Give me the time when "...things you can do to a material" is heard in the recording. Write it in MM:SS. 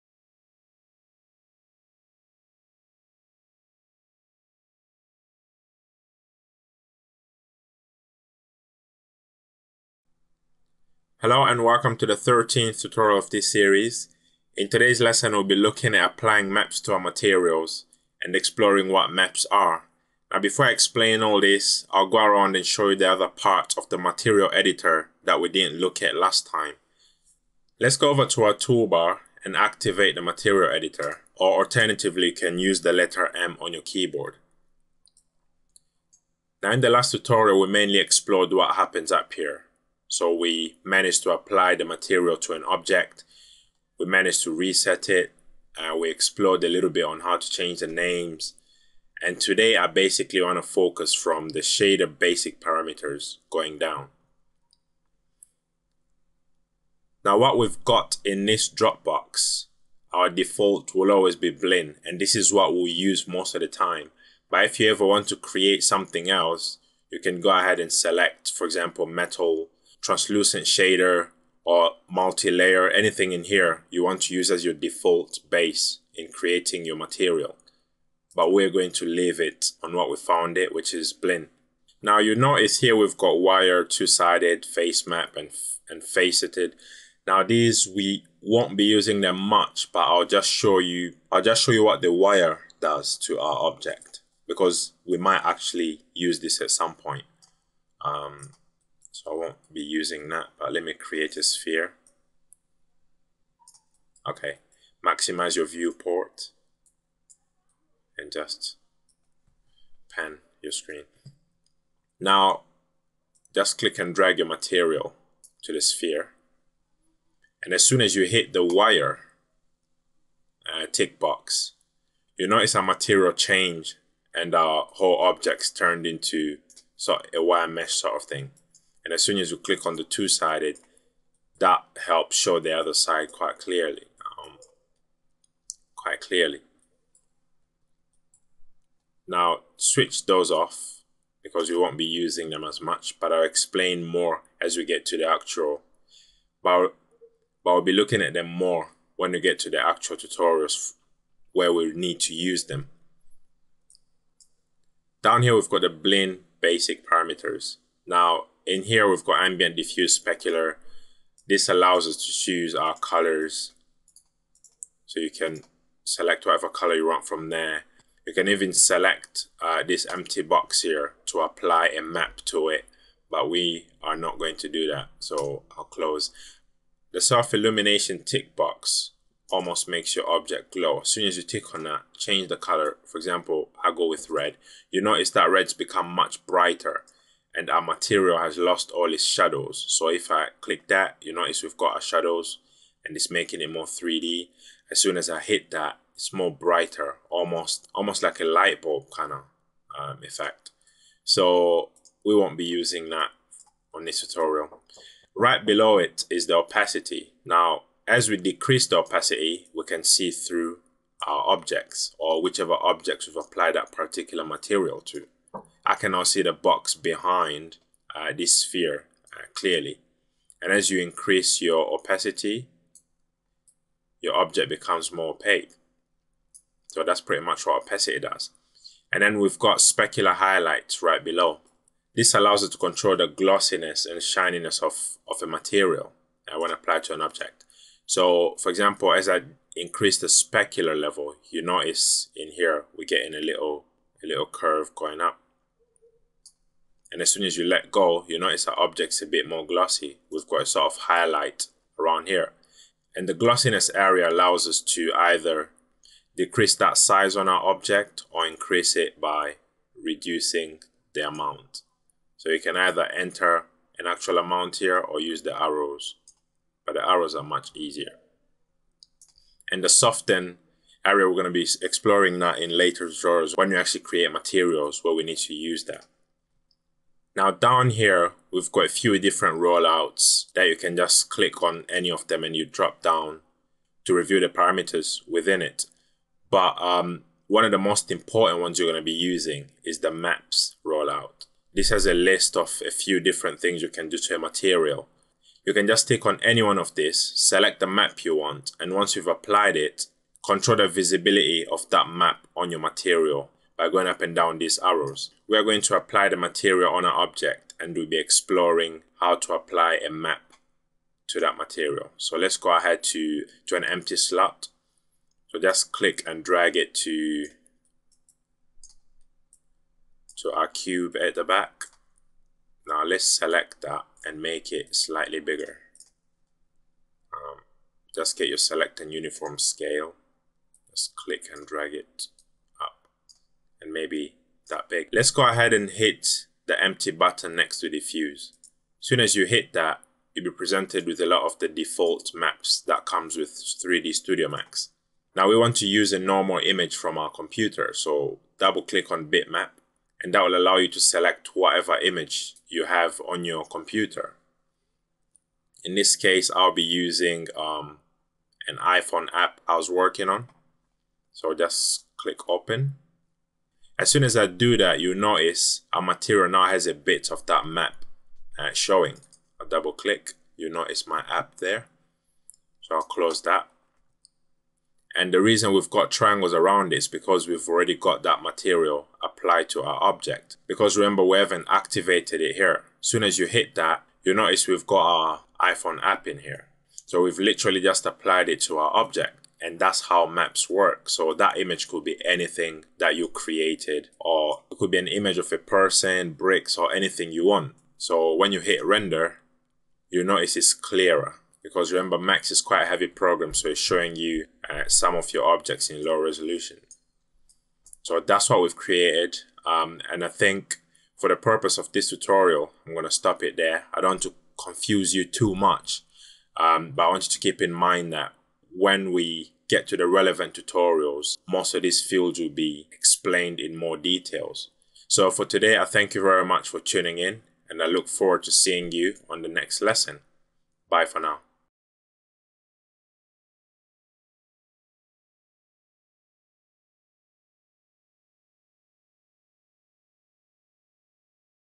04:53.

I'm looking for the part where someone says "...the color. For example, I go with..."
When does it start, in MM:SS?
03:02.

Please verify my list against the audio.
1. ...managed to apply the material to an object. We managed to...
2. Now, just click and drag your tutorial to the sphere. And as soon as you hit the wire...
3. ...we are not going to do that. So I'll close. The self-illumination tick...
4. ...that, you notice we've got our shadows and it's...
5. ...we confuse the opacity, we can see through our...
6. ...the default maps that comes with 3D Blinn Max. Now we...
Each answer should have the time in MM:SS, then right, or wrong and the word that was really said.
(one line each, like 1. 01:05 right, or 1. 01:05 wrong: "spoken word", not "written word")
1. 00:40 right
2. 01:52 wrong: "material", not "tutorial"
3. 02:53 right
4. 03:10 right
5. 03:28 wrong: "decrease", not "confuse"
6. 05:41 wrong: "Studio", not "Blinn".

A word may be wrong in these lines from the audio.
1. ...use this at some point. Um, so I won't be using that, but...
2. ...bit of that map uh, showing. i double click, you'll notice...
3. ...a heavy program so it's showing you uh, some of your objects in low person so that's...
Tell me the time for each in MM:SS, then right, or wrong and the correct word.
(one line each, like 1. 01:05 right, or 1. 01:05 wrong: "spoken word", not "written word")
1. 01:36 right
2. 06:06 right
3. 06:42 wrong: "resolution", not "person".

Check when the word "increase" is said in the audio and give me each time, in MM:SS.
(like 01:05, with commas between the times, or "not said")
03:41, 03:59, 04:18.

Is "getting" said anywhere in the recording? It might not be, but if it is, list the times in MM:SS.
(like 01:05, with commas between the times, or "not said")
04:03.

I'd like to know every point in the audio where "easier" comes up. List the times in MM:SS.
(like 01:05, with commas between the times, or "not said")
04:27.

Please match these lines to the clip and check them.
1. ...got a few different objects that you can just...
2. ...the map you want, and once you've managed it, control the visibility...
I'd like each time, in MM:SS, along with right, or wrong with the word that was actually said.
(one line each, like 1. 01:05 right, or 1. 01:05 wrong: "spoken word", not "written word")
1. 04:38 wrong: "rollouts", not "objects"
2. 04:57 wrong: "applied", not "managed".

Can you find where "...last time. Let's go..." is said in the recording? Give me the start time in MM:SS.
00:26.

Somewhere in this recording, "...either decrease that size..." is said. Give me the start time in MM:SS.
04:15.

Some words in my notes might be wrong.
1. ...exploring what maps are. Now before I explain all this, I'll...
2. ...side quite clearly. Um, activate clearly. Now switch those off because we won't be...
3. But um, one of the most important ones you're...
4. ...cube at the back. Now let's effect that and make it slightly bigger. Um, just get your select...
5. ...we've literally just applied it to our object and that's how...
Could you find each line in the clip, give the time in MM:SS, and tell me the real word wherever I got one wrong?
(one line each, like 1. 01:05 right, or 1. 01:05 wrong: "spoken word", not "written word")
1. 00:18 right
2. 02:12 wrong: "quite", not "activate"
3. 04:46 right
4. 05:20 wrong: "select", not "effect"
5. 06:27 right.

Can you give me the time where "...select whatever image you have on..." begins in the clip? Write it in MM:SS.
05:50.